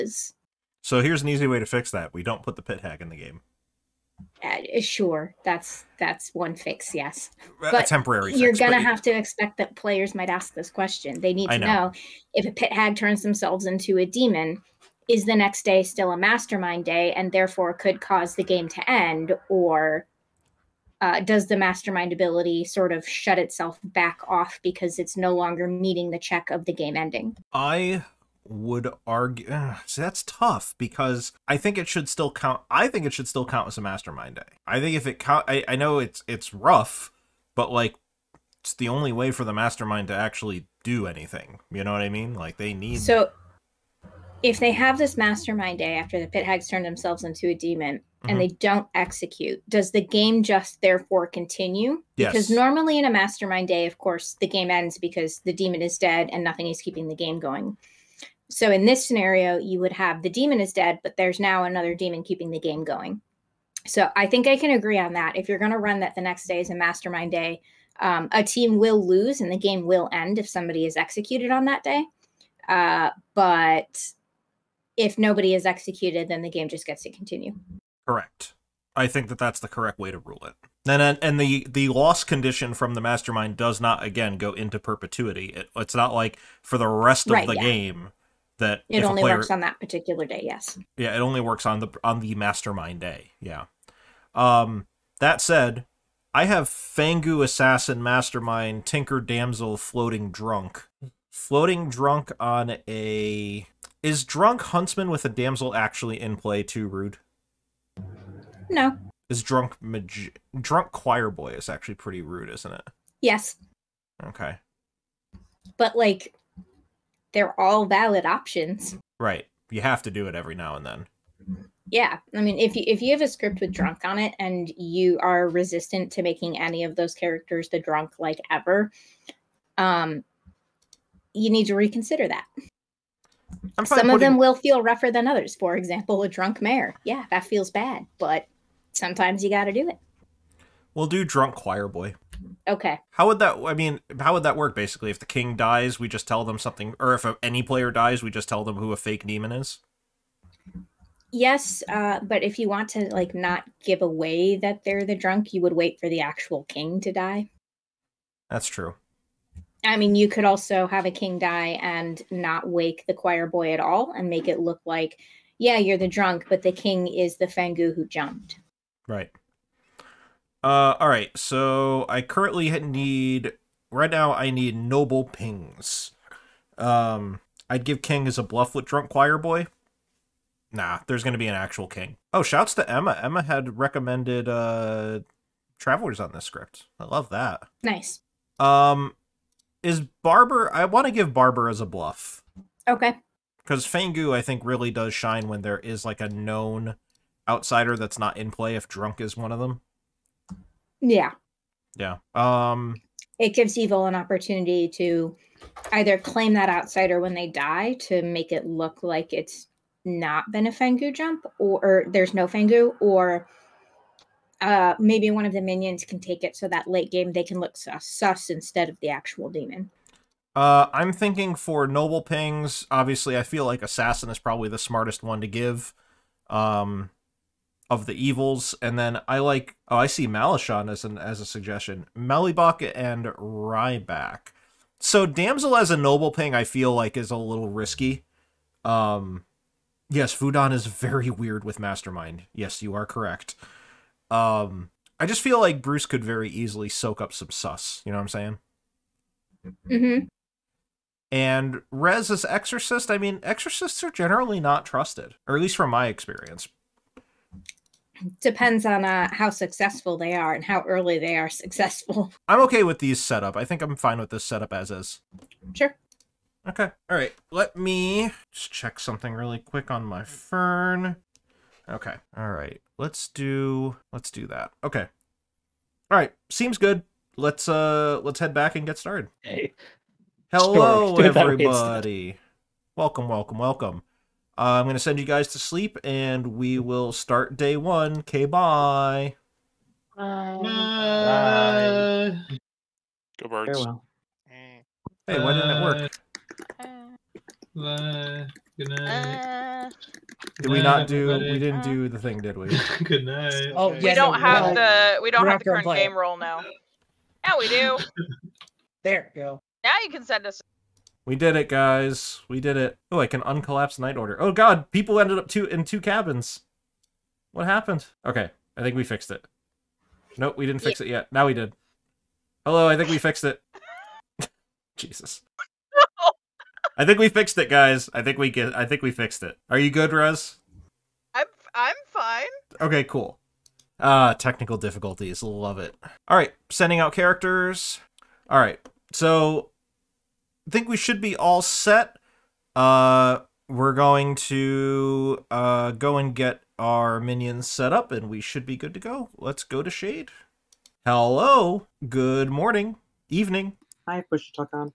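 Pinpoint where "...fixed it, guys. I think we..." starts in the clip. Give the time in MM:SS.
05:27.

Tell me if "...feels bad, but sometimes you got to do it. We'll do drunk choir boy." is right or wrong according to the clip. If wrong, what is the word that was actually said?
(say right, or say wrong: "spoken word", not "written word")
right.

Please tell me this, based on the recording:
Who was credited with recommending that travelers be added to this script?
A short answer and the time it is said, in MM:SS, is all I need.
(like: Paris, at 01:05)
Emma, at 03:03.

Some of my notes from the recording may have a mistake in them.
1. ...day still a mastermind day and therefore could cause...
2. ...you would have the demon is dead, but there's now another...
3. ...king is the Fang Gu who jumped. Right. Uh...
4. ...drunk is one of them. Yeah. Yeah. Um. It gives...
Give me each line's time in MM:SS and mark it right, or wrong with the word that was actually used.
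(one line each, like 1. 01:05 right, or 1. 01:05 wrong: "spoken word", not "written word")
1. 00:15 right
2. 00:59 right
3. 02:46 right
4. 03:18 right.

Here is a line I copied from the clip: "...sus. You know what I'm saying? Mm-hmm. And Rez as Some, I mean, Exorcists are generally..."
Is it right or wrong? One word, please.
wrong.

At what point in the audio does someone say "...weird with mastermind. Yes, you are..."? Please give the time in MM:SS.
04:01.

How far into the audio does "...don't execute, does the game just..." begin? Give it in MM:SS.
00:48.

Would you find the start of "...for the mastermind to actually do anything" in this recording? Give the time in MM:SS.
00:39.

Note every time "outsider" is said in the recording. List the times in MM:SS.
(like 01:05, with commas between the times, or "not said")
03:17, 03:26.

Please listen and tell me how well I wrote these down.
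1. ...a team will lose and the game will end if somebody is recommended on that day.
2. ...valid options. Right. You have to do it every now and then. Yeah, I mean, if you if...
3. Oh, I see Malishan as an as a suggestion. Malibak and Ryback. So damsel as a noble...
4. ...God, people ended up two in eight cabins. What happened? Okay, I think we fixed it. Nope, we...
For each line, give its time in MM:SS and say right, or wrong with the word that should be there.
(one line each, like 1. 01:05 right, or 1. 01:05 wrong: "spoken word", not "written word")
1. 01:08 wrong: "executed", not "recommended"
2. 01:57 right
3. 03:49 right
4. 05:14 wrong: "two", not "eight".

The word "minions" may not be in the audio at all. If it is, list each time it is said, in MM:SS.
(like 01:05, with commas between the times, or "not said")
03:35, 05:47.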